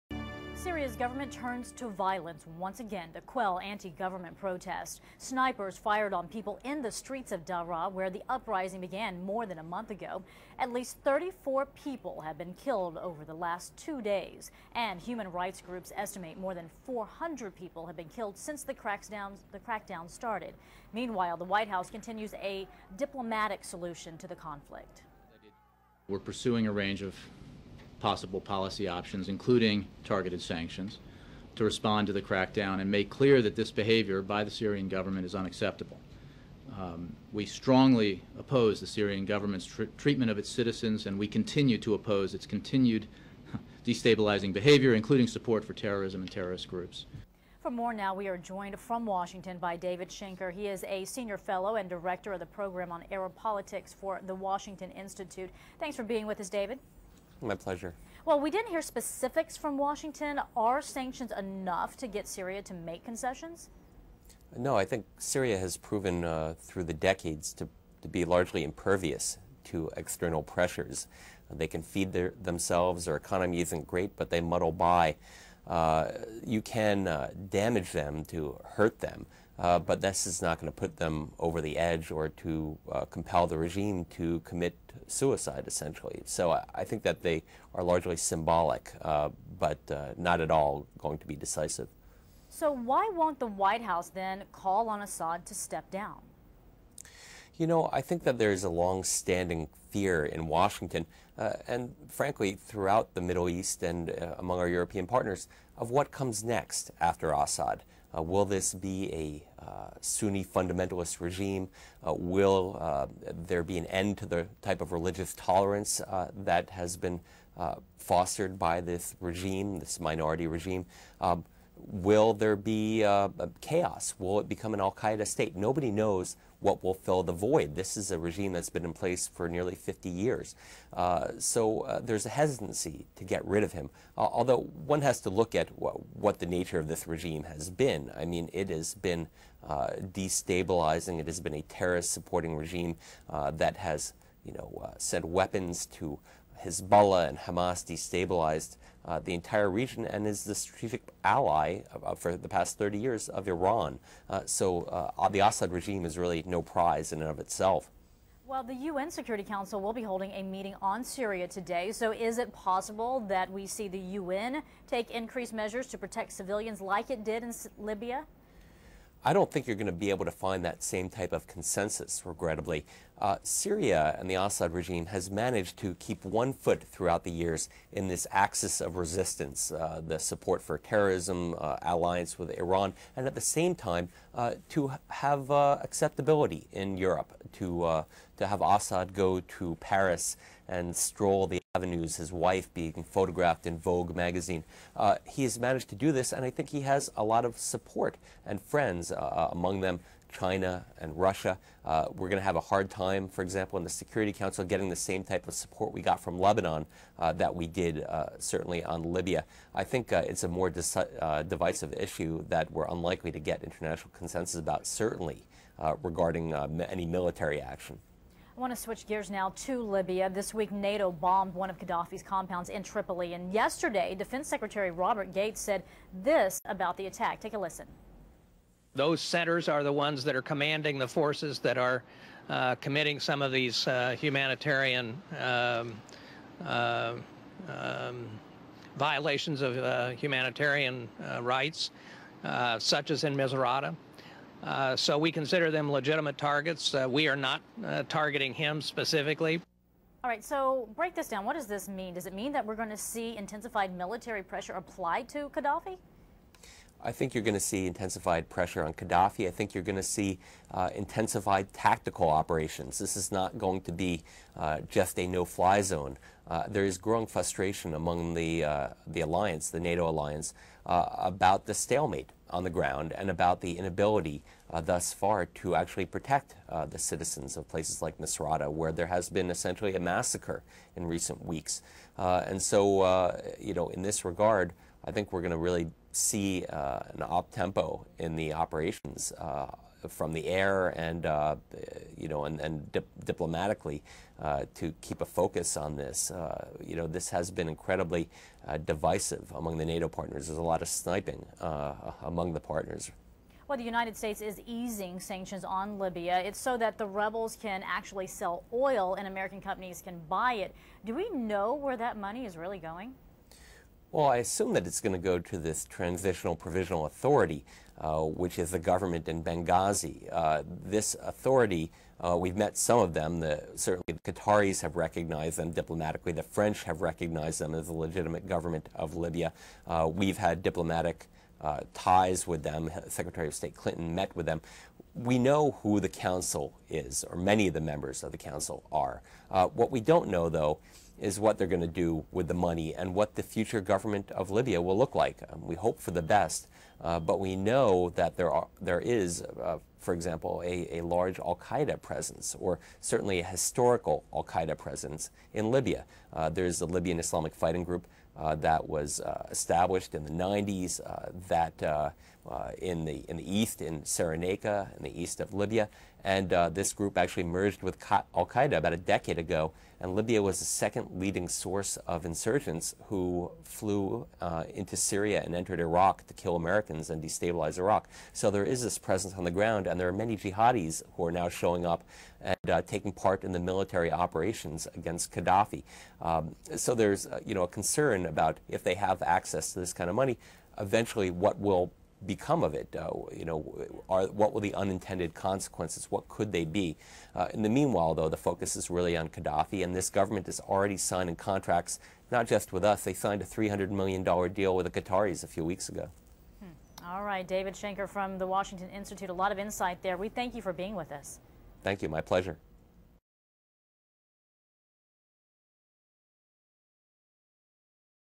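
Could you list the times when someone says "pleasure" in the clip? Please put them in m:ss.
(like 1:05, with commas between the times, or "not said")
0:57, 6:52.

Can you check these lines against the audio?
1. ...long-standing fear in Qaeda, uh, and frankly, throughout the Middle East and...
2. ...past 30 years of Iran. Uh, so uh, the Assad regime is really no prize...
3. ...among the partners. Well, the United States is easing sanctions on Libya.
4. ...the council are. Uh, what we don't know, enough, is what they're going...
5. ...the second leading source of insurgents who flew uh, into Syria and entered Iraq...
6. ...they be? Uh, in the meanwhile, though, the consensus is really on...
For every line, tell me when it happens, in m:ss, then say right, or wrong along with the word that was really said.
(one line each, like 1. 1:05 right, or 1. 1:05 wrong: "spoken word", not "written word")
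1. 1:38 wrong: "Washington", not "Qaeda"
2. 2:32 right
3. 5:02 right
4. 5:38 wrong: "though", not "enough"
5. 6:10 right
6. 6:36 wrong: "focus", not "consensus".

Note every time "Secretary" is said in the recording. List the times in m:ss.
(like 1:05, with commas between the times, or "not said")
3:44, 5:33.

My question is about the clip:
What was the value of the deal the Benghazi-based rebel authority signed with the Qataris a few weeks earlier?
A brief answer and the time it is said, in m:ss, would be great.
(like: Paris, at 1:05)
$300 million, at 6:43.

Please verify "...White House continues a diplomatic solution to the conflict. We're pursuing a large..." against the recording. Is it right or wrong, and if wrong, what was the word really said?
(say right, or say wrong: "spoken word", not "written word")
wrong: "range", not "large".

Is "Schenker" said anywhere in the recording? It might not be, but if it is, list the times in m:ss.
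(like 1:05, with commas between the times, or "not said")
0:50, 6:47.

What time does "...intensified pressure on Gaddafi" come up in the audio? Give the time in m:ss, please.
4:17.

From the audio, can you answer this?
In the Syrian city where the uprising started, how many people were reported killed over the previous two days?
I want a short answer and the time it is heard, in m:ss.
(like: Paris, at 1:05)
34, at 0:10.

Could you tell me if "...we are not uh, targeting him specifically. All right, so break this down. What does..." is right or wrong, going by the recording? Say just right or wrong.
right.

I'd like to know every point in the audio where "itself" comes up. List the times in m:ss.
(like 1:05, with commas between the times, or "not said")
2:37.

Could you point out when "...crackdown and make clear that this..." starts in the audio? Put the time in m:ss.
0:32.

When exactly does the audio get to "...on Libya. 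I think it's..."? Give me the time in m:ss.
3:28.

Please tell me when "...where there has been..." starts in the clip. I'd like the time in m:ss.
4:38.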